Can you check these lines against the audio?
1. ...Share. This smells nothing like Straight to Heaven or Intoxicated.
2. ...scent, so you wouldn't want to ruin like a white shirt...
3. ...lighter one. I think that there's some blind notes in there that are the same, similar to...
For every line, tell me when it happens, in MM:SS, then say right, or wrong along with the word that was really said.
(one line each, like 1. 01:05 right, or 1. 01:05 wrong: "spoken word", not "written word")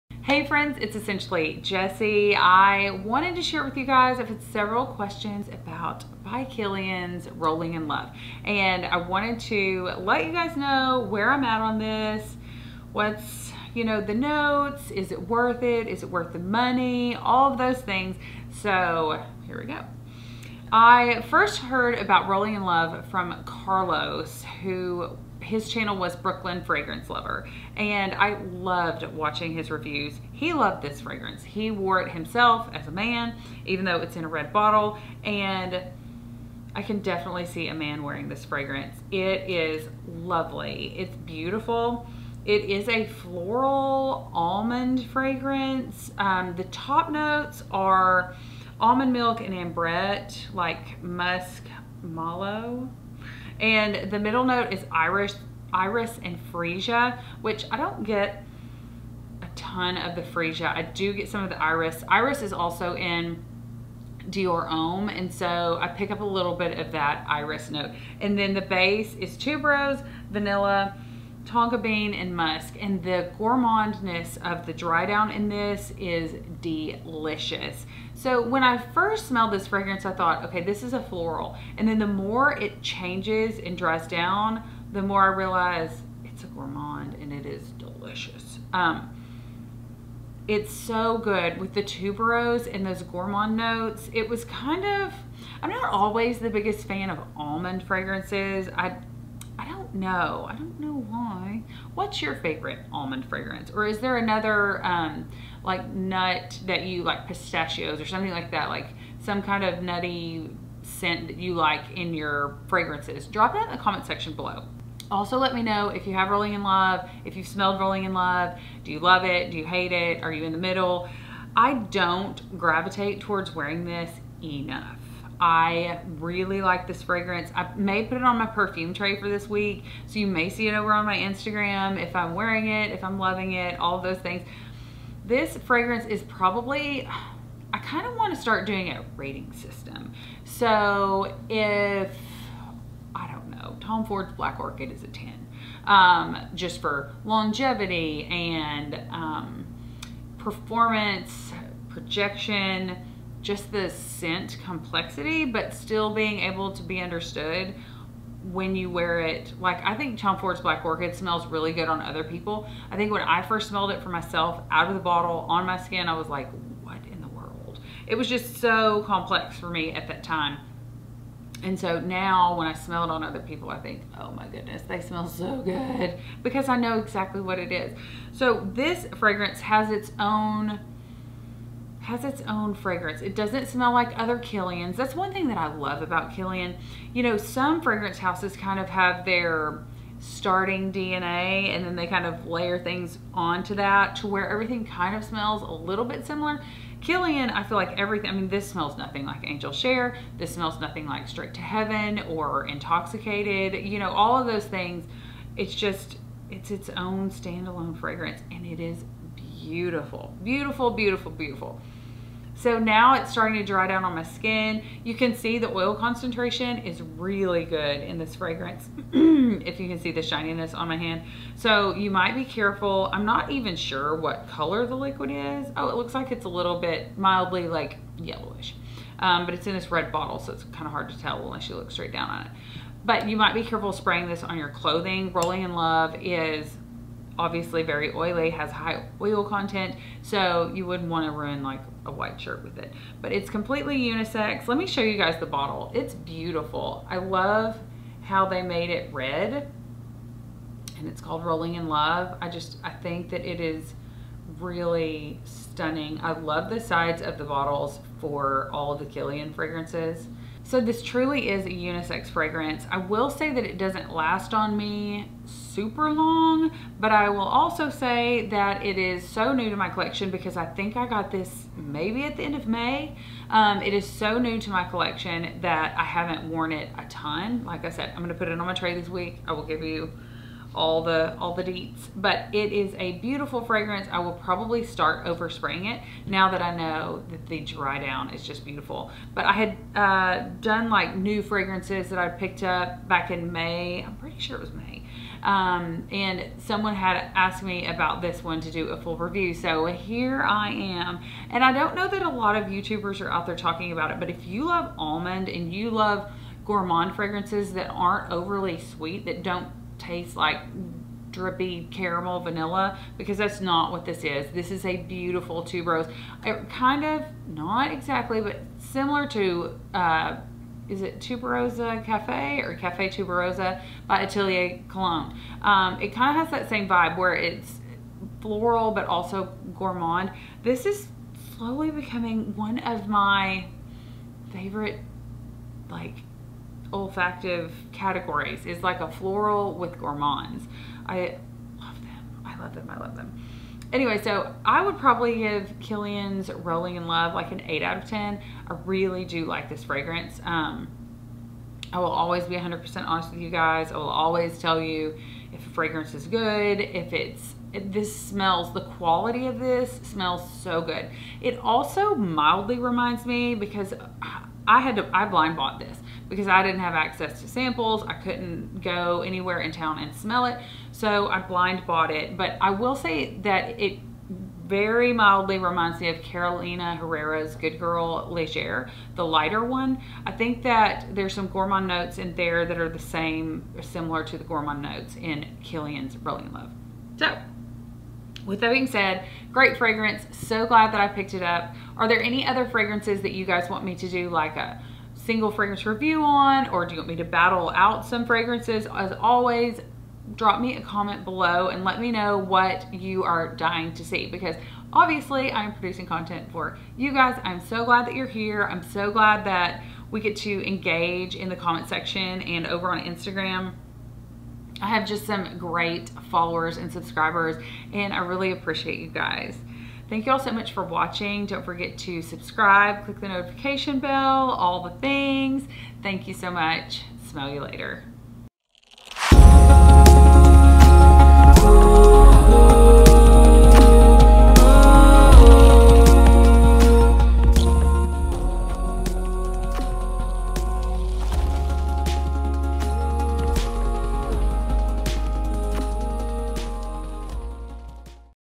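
1. 03:19 right
2. 03:59 wrong: "content", not "scent"
3. 06:19 wrong: "gourmand", not "blind".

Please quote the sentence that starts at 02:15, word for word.
This fragrance is probably, I kind of want to start doing a rating system.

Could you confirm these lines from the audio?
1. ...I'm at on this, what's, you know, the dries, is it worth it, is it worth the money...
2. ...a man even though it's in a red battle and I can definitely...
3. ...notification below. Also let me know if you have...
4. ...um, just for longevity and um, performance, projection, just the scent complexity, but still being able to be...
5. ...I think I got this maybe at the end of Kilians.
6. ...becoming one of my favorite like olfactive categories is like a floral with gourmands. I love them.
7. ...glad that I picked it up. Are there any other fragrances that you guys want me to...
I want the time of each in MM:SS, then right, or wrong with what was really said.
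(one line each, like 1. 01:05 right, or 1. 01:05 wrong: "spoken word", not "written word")
1. 00:11 wrong: "notes", not "dries"
2. 00:32 wrong: "bottle", not "battle"
3. 01:54 wrong: "section", not "notification"
4. 02:25 right
5. 04:30 wrong: "May", not "Kilians"
6. 05:31 right
7. 06:30 right.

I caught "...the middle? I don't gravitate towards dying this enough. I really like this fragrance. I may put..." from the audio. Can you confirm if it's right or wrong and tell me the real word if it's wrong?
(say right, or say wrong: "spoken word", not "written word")
wrong: "wearing", not "dying".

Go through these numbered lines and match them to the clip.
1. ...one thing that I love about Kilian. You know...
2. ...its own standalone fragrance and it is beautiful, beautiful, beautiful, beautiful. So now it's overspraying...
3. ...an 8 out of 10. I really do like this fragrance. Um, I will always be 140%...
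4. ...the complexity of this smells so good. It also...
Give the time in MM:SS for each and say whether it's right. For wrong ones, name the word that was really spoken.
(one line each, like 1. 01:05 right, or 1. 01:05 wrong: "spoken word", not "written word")
1. 03:05 right
2. 03:26 wrong: "starting", not "overspraying"
3. 05:47 wrong: "100", not "140"
4. 05:58 wrong: "quality", not "complexity".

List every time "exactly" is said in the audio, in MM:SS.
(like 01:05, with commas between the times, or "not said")
02:56, 05:17.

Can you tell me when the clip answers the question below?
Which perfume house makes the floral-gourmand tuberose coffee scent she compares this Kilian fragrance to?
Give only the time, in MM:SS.
05:24.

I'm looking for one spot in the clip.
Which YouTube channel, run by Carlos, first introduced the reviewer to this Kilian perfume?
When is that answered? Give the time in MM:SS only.
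00:26.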